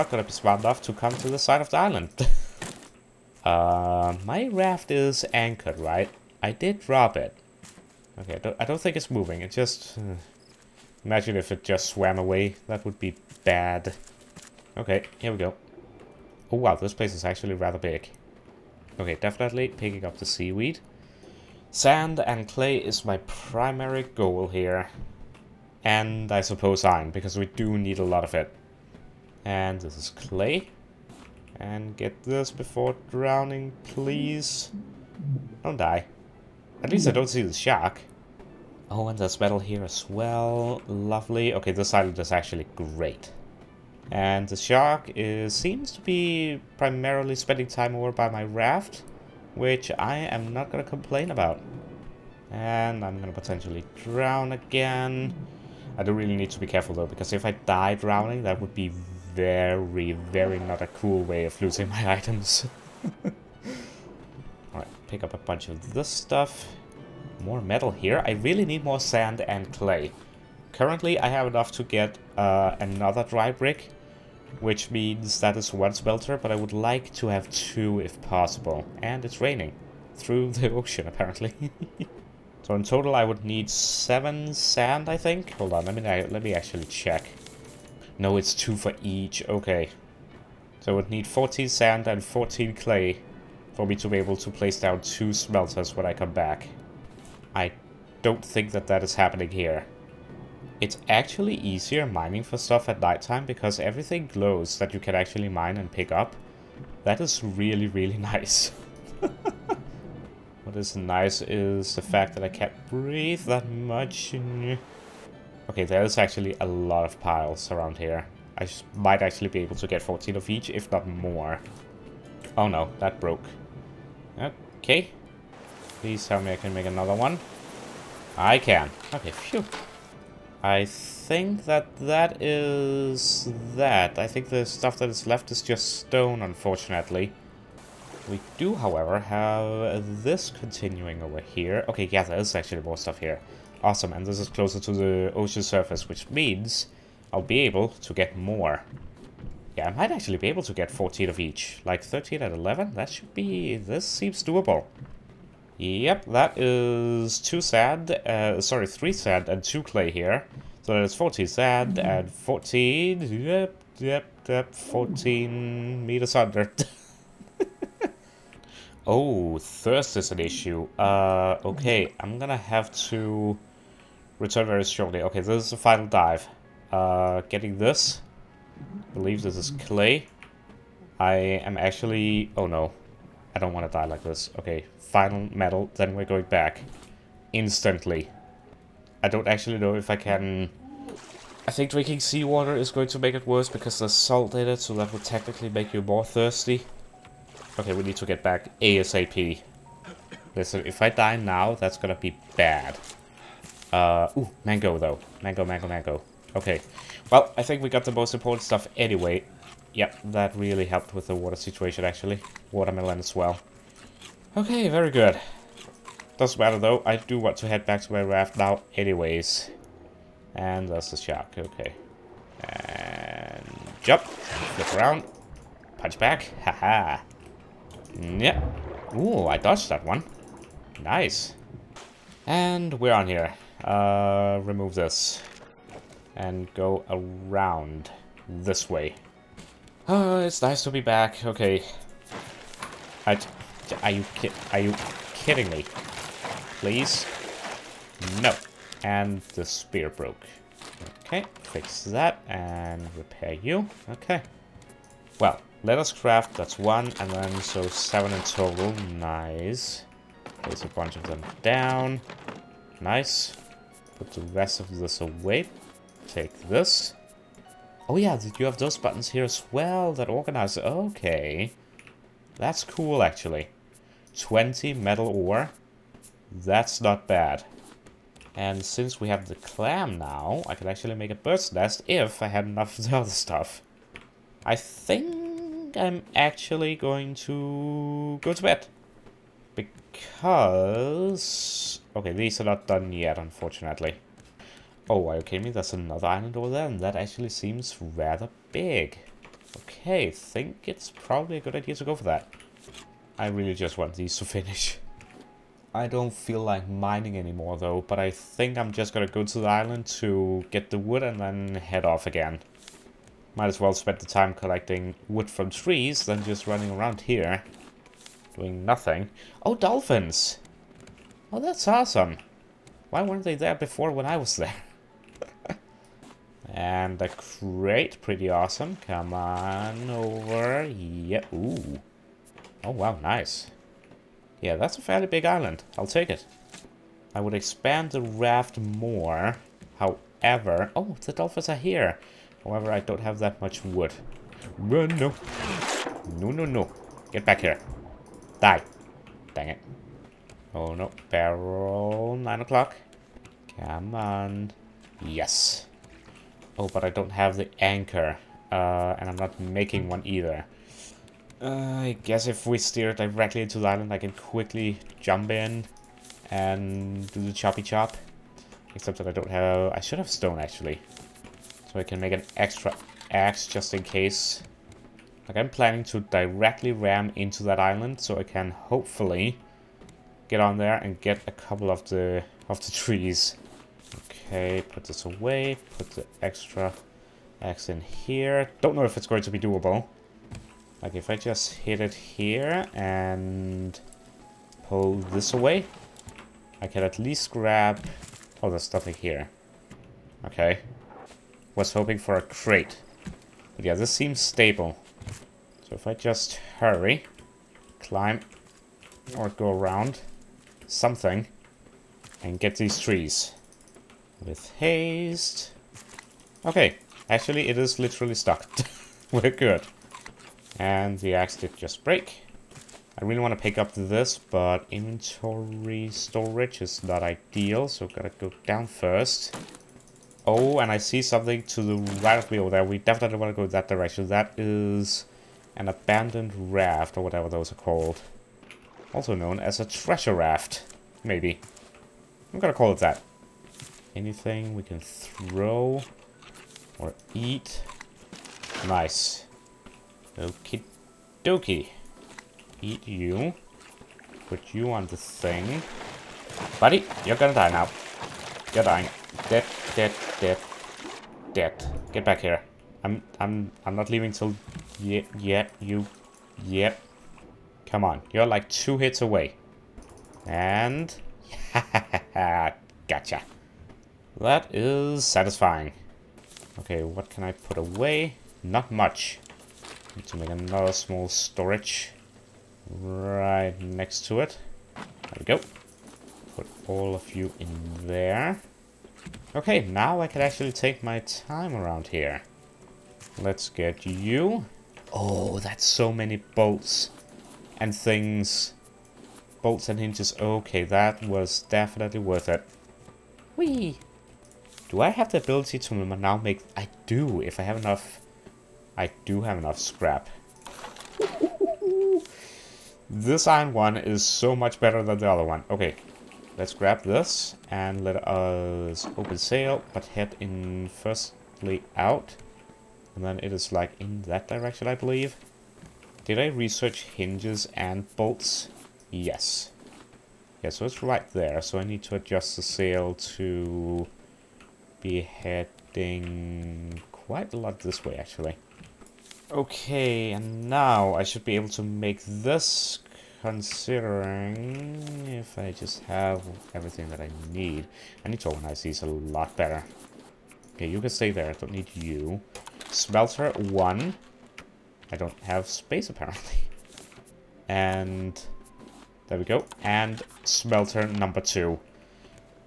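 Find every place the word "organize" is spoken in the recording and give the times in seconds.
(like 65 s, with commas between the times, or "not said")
270 s, 548 s.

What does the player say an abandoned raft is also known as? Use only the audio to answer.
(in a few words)
Treasure raft.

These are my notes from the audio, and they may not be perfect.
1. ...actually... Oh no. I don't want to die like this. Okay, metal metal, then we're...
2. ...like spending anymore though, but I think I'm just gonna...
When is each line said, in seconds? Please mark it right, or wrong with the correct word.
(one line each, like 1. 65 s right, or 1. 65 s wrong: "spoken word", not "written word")
1. 181 s wrong: "final", not "metal"
2. 306 s wrong: "mining", not "spending".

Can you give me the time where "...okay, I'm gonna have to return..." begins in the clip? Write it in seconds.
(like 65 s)
171 s.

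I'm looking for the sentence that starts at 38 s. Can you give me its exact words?
Oh, and there's metal here as well.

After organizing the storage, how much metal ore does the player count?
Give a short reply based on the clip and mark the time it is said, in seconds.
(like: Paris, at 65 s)
20, at 274 s.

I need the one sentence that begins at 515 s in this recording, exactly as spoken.
Okay, Let's grab this and let us open sail, but head in firstly out.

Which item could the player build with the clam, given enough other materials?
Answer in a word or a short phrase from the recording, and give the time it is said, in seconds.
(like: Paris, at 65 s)
Bird's nest, at 281 s.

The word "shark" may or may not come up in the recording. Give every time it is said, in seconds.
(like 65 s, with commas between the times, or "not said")
37 s, 44 s, 221 s.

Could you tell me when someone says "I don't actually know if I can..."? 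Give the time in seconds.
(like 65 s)
189 s.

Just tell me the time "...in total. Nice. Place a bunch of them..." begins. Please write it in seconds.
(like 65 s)
258 s.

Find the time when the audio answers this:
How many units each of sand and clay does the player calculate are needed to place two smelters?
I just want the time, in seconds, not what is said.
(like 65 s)
91 s.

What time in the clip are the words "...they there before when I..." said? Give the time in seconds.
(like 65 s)
323 s.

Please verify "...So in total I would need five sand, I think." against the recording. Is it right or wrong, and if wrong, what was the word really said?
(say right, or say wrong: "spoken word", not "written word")
wrong: "seven", not "five".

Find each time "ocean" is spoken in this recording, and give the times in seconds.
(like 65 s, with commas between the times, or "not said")
80 s, 145 s.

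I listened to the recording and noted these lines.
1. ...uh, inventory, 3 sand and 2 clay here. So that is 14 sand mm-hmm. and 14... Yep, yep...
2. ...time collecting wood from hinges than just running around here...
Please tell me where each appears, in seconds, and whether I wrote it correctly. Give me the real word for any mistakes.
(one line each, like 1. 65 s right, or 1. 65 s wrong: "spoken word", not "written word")
1. 158 s wrong: "sorry", not "inventory"
2. 314 s wrong: "trees", not "hinges".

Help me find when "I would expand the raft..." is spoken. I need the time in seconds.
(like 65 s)
337 s.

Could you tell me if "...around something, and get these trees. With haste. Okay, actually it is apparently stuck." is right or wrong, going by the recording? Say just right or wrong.
wrong.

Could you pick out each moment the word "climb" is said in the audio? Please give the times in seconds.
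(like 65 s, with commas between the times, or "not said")
408 s.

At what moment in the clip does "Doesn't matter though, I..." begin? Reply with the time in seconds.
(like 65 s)
216 s.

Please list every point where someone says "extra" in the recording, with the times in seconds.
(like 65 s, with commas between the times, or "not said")
372 s, 386 s.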